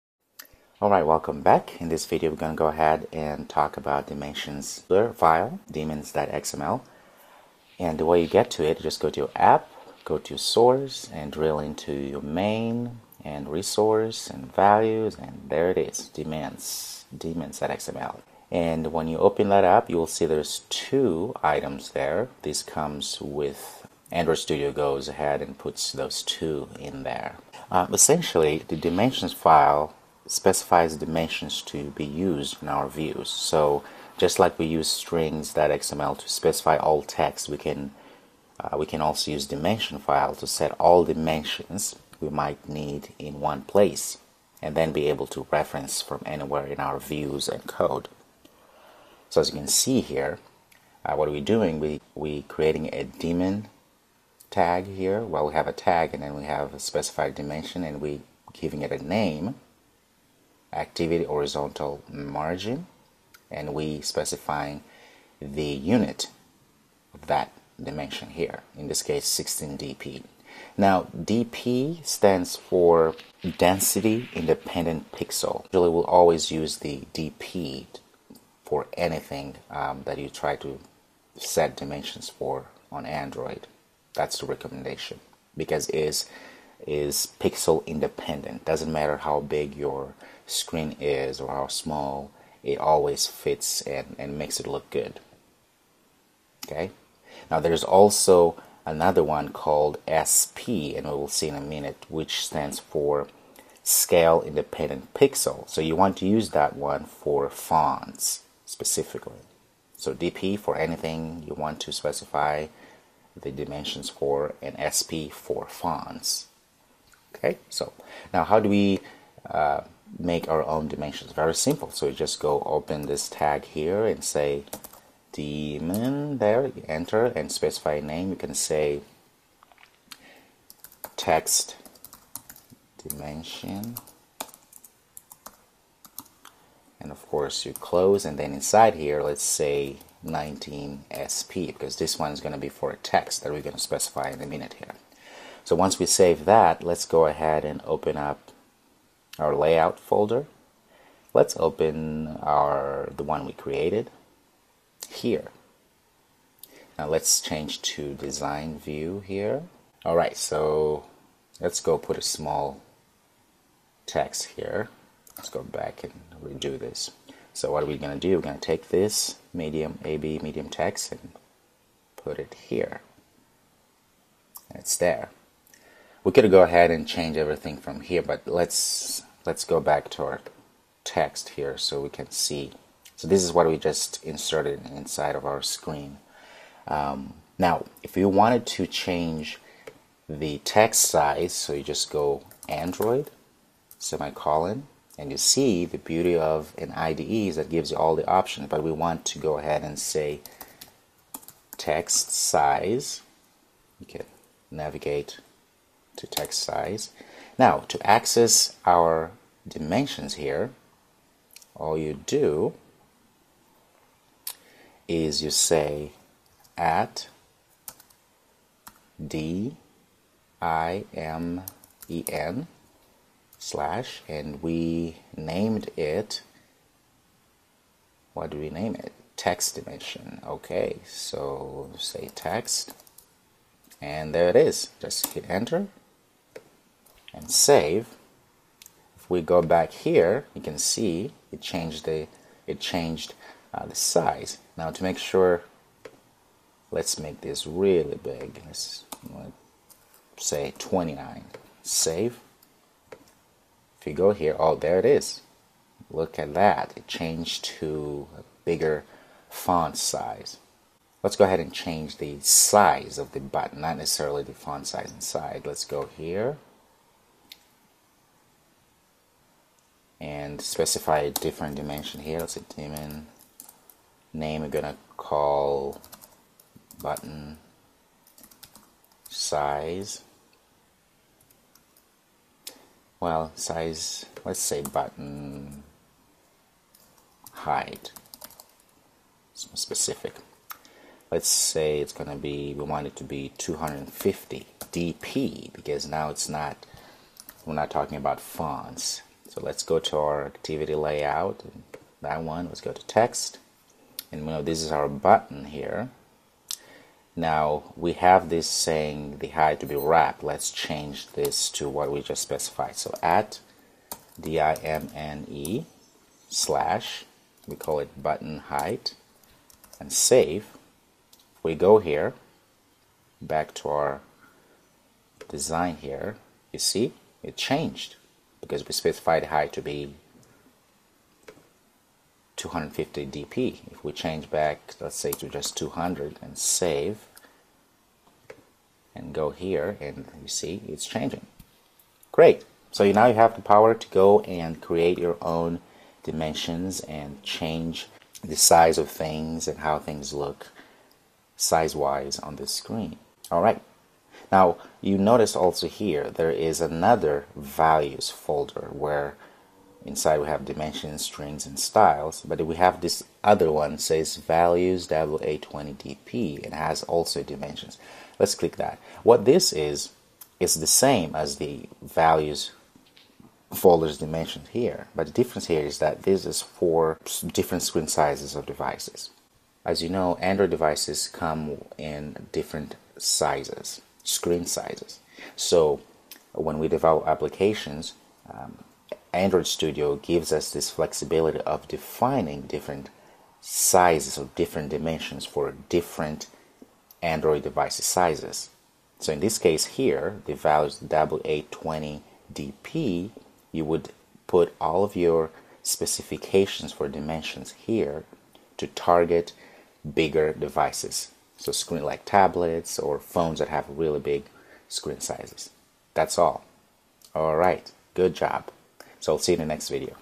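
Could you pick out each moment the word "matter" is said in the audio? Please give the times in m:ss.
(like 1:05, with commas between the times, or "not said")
1:28.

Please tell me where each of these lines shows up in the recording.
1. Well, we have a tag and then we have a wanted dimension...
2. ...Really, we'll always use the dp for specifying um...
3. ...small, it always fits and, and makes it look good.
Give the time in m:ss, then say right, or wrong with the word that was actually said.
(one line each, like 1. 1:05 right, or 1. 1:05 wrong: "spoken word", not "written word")
1. 0:55 wrong: "specified", not "wanted"
2. 1:15 wrong: "anything", not "specifying"
3. 1:31 right.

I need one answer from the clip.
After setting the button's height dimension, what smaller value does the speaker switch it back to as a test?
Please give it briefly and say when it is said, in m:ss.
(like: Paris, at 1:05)
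200, at 5:35.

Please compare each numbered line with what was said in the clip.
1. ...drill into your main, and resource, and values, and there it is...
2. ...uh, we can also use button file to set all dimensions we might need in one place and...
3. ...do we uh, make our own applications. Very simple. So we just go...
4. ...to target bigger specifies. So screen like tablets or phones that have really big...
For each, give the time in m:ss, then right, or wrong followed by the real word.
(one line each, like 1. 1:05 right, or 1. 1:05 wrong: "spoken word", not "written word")
1. 0:11 right
2. 0:38 wrong: "dimension", not "button"
3. 1:58 wrong: "dimensions", not "applications"
4. 6:48 wrong: "devices", not "specifies".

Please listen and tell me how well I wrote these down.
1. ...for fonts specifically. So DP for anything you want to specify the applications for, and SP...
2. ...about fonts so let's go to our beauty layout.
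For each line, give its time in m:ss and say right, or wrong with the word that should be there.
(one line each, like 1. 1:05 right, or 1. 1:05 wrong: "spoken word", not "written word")
1. 1:47 wrong: "dimensions", not "applications"
2. 4:58 wrong: "activity", not "beauty".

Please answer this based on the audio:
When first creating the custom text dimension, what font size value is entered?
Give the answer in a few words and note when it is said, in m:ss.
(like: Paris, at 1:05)
19 SP, at 2:20.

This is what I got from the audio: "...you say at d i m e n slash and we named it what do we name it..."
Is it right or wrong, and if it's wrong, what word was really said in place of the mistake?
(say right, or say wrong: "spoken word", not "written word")
right.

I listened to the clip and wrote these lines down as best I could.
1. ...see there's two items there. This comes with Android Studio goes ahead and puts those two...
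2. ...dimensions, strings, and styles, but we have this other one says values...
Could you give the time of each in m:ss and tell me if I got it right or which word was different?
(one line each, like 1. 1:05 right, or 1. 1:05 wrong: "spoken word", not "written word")
1. 0:20 right
2. 6:00 right.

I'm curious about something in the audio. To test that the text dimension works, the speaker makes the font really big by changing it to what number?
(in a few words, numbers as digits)
29.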